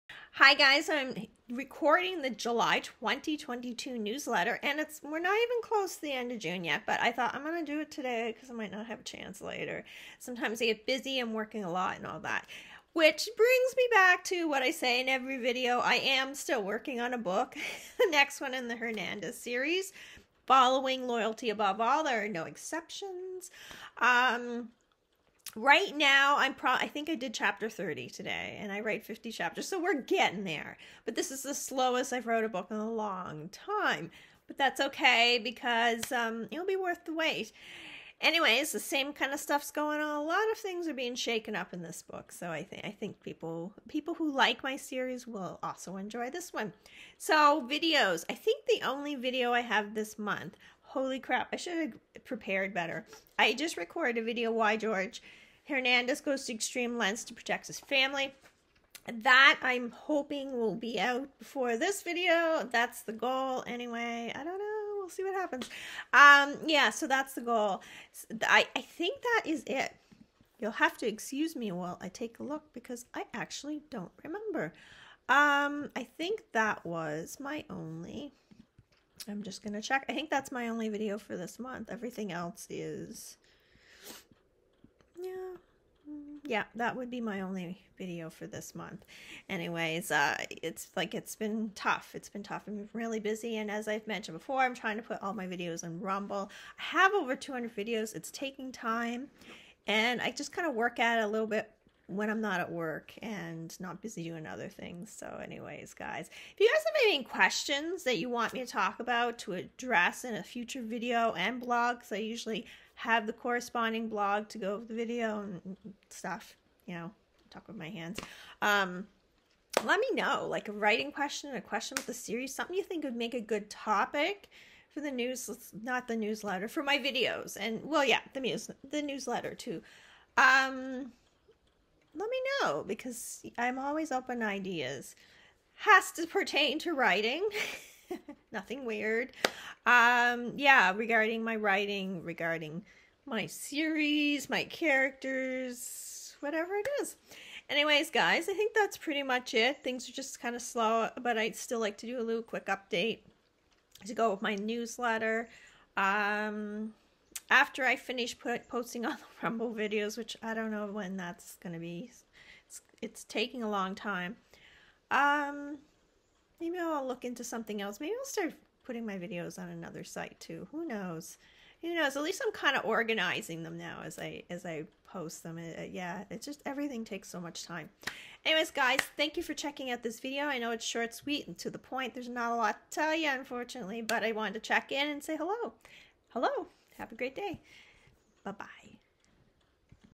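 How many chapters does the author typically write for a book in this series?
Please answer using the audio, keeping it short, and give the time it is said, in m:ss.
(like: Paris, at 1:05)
50, at 0:29.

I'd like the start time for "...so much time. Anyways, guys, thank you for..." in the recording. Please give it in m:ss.
2:57.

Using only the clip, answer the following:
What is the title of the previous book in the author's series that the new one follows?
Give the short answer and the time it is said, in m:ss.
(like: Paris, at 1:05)
Loyalty Above All, at 0:21.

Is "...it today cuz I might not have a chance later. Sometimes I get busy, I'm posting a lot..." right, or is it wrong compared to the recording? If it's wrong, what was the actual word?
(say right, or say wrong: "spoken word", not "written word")
wrong: "working", not "posting".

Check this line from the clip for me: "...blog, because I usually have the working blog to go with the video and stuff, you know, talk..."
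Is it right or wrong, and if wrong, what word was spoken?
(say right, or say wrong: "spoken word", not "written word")
wrong: "corresponding", not "working".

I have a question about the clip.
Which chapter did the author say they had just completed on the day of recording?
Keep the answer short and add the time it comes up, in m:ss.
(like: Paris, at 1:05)
Chapter 30, at 0:27.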